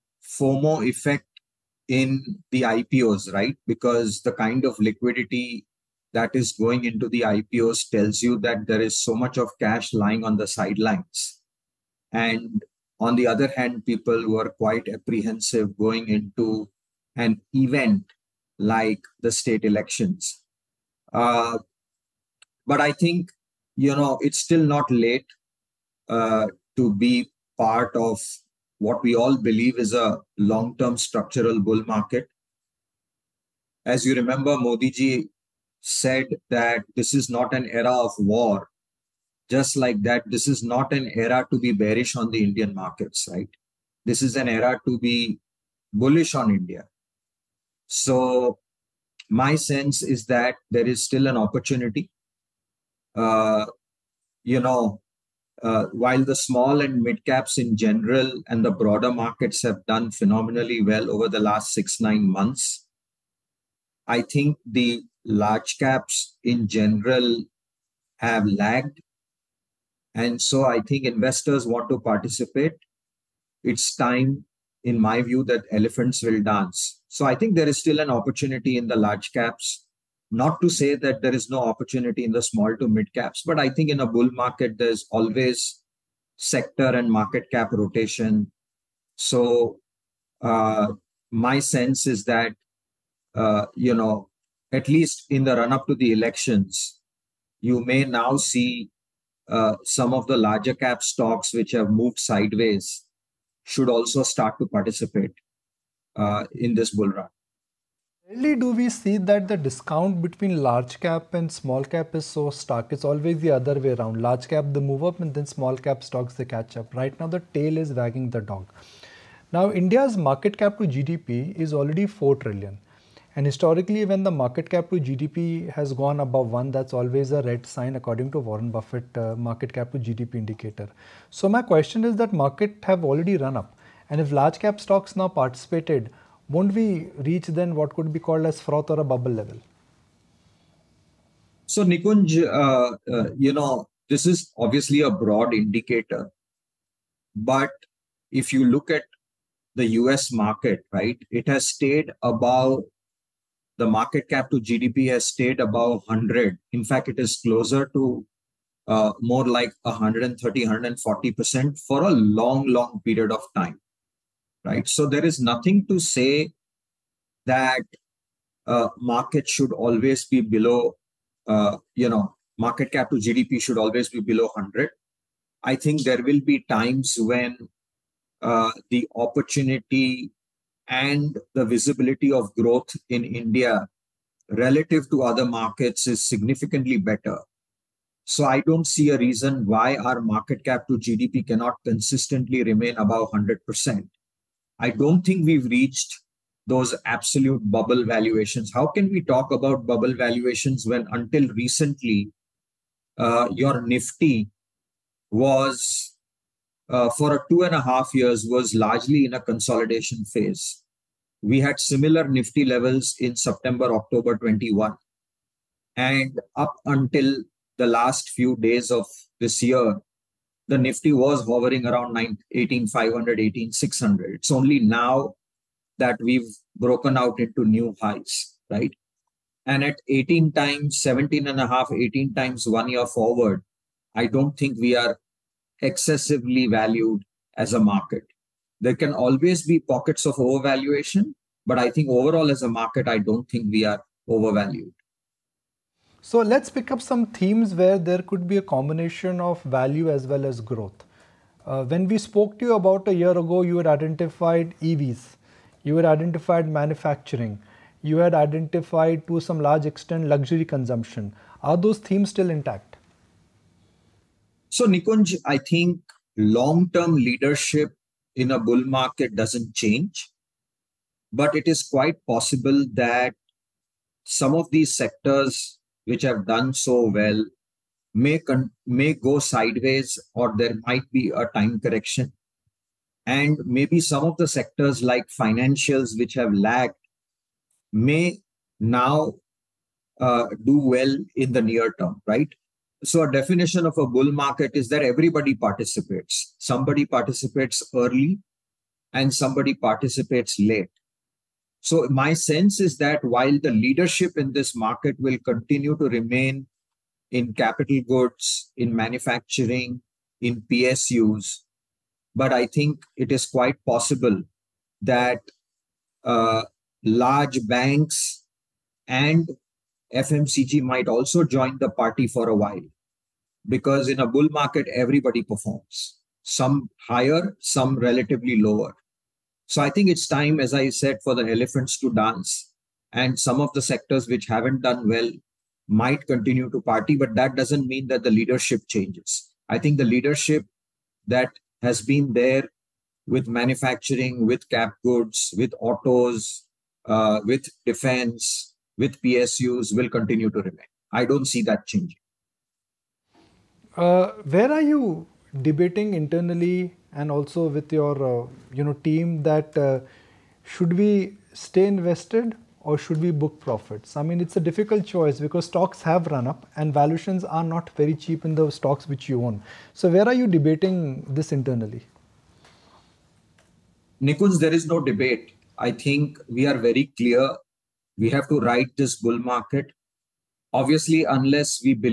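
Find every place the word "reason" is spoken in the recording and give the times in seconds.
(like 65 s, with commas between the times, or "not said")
189 s.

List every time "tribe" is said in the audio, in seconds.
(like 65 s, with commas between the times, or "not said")
not said.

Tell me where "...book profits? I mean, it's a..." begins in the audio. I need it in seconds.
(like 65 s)
363 s.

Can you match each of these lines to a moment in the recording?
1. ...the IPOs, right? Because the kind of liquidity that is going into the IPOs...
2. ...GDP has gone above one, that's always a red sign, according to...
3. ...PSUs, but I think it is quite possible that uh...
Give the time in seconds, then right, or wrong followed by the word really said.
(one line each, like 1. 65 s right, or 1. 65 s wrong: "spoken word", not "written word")
1. 2 s right
2. 124 s right
3. 310 s right.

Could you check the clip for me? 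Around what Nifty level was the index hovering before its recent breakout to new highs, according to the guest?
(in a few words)
18,500.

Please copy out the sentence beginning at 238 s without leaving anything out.
There can always be pockets of overvaluation, but I think overall as a market, I don't think we are overvalued.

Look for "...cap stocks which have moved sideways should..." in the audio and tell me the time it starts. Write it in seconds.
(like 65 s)
100 s.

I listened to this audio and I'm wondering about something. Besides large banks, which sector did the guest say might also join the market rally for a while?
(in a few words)
FMCG.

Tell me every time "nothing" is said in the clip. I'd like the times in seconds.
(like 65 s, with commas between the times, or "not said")
165 s.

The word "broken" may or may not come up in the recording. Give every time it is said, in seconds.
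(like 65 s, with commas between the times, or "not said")
226 s.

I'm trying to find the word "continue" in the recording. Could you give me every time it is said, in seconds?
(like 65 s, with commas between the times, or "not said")
305 s, 336 s, 350 s.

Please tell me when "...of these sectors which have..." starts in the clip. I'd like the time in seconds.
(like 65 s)
274 s.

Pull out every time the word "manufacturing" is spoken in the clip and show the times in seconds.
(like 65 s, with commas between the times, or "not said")
256 s, 308 s, 343 s.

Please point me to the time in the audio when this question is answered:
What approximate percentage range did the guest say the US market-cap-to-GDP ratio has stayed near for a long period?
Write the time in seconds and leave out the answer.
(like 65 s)
159 s.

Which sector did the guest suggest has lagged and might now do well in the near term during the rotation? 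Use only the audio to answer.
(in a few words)
financials.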